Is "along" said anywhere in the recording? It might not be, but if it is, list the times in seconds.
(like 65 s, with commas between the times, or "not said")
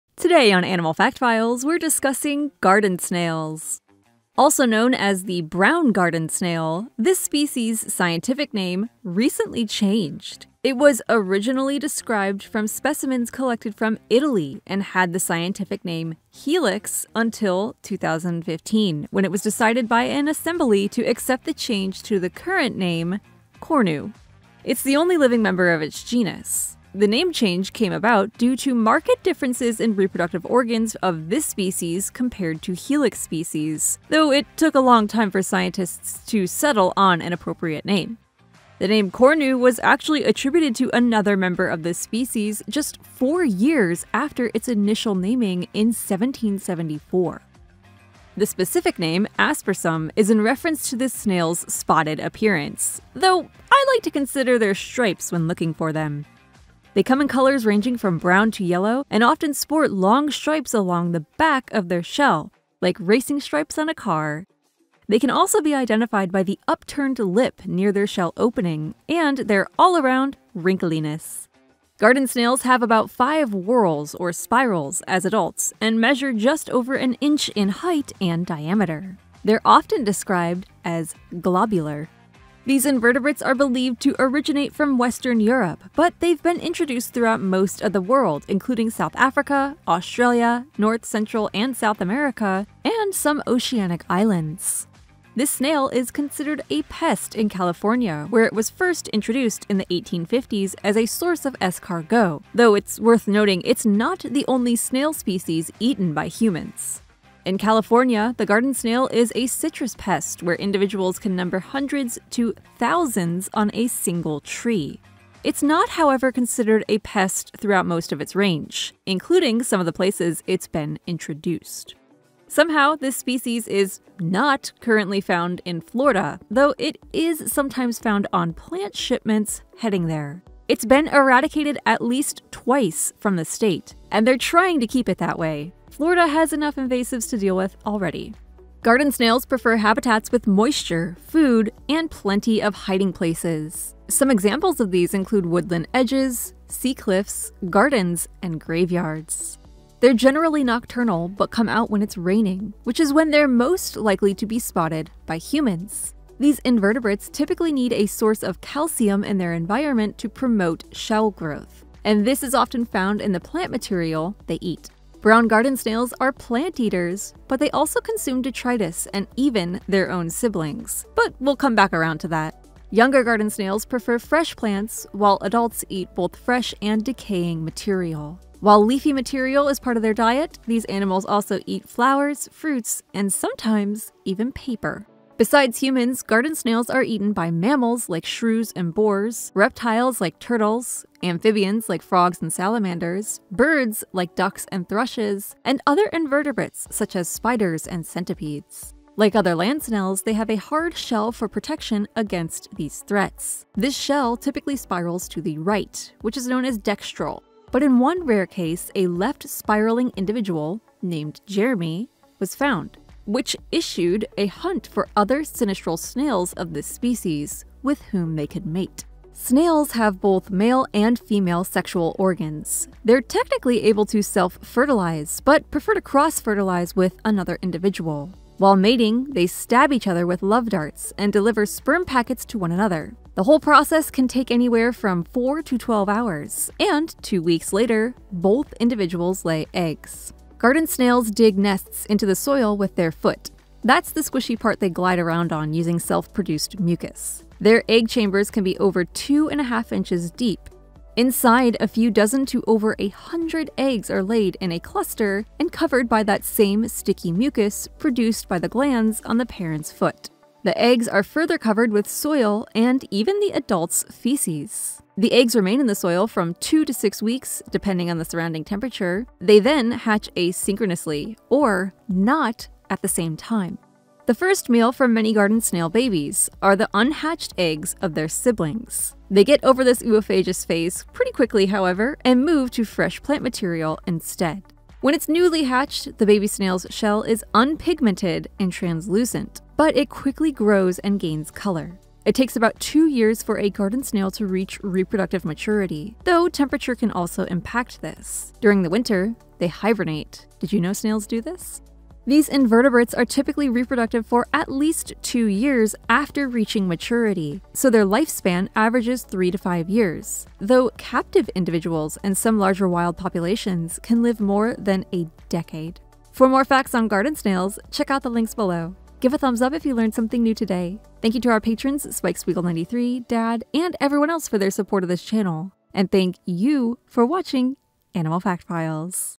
60 s.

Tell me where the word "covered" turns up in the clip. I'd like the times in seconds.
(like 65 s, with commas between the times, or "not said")
255 s, 261 s.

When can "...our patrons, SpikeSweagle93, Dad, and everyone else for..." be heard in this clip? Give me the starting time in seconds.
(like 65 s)
321 s.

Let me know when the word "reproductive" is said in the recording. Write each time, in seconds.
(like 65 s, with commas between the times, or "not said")
29 s, 294 s, 303 s.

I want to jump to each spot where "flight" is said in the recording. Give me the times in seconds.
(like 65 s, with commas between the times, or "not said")
not said.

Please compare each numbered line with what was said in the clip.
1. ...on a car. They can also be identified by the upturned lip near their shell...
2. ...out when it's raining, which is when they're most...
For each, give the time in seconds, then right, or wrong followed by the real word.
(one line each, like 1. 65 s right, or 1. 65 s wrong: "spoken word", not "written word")
1. 63 s right
2. 151 s right.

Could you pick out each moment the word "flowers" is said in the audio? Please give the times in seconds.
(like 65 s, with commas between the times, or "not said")
181 s.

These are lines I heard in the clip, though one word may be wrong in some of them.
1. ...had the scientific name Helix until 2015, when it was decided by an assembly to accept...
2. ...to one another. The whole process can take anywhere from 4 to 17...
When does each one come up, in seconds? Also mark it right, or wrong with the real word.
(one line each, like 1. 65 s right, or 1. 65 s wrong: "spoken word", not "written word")
1. 14 s right
2. 232 s wrong: "12", not "17".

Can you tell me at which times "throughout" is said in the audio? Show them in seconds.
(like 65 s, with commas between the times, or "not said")
87 s, 117 s.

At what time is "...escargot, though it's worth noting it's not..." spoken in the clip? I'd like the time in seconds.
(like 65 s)
101 s.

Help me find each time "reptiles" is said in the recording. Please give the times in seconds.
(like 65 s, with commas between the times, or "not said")
189 s.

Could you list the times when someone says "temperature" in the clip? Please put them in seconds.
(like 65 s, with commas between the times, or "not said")
268 s, 296 s.